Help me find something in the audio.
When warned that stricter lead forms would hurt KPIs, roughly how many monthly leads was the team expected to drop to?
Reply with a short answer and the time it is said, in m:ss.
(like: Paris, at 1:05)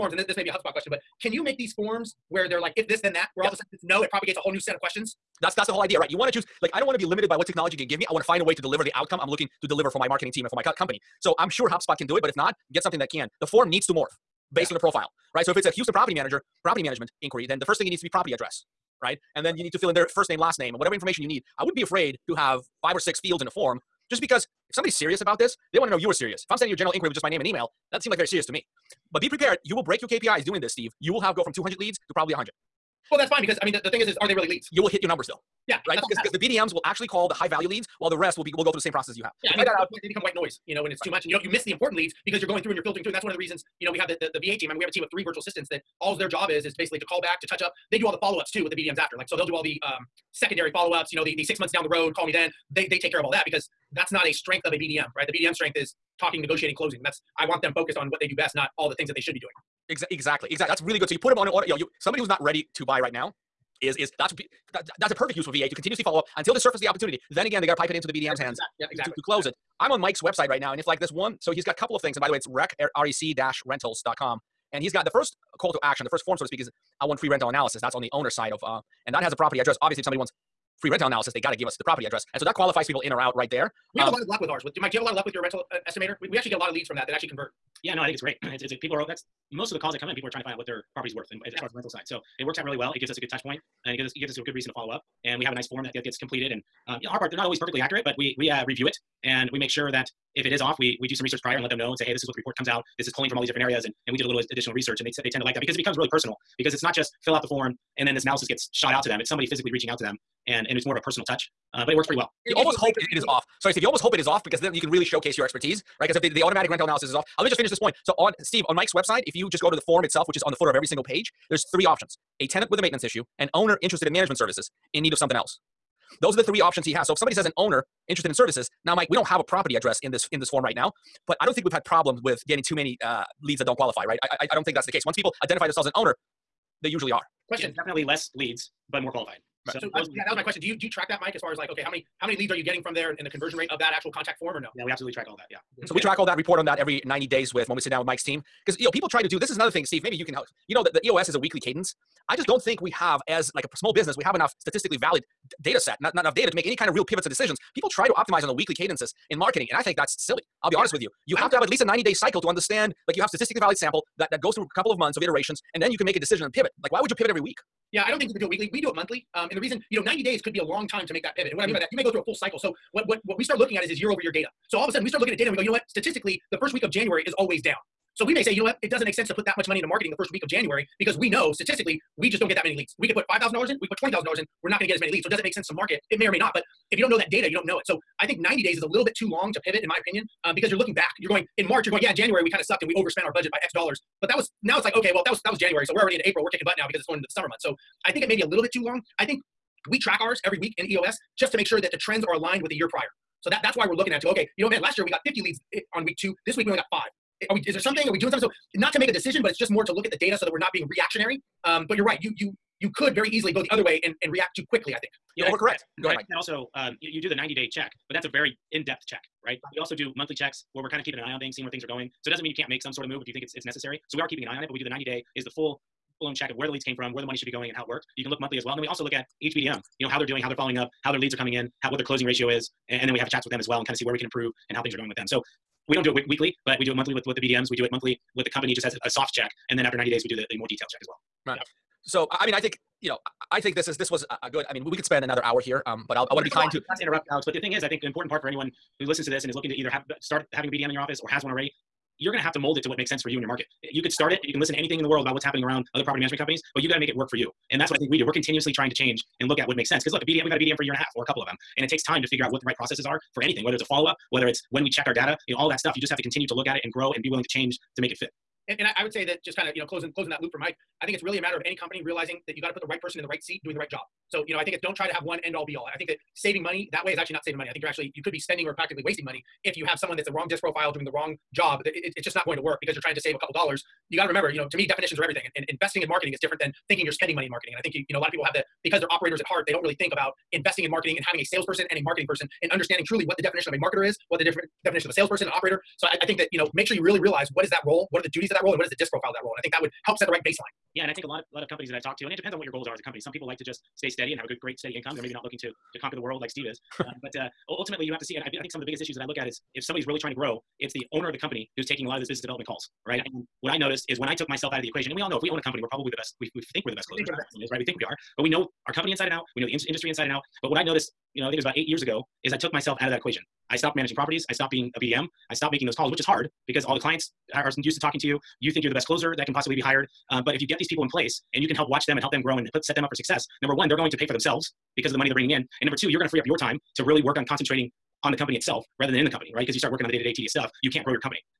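100, at 0:32.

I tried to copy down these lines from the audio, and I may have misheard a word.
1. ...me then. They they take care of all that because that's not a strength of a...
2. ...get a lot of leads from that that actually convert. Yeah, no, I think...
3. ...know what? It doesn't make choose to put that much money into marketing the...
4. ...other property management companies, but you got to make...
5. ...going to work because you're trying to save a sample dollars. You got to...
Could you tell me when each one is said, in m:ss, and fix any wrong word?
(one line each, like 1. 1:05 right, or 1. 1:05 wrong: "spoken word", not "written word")
1. 0:52 right
2. 1:26 right
3. 2:58 wrong: "sense", not "choose"
4. 4:15 right
5. 4:42 wrong: "couple", not "sample".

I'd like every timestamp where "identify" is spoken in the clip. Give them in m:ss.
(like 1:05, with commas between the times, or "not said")
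2:15.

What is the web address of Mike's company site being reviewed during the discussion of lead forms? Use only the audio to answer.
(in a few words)
rec-rentals.com.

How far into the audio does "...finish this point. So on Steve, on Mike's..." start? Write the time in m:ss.
1:57.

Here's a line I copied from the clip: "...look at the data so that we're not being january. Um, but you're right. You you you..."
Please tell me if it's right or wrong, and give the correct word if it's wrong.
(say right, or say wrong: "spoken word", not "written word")
wrong: "reactionary", not "january".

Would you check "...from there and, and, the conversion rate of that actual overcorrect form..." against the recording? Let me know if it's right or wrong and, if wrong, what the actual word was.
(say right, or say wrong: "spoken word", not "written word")
wrong: "contact", not "overcorrect".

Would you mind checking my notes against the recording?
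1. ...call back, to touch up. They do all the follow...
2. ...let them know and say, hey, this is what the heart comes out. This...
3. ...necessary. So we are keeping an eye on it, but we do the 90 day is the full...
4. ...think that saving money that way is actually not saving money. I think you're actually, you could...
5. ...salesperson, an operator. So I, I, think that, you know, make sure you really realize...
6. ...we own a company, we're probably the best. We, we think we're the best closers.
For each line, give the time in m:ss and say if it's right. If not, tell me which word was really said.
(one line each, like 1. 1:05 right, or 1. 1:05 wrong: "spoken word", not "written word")
1. 0:47 right
2. 1:41 wrong: "report", not "heart"
3. 3:43 right
4. 4:35 right
5. 4:55 right
6. 5:15 right.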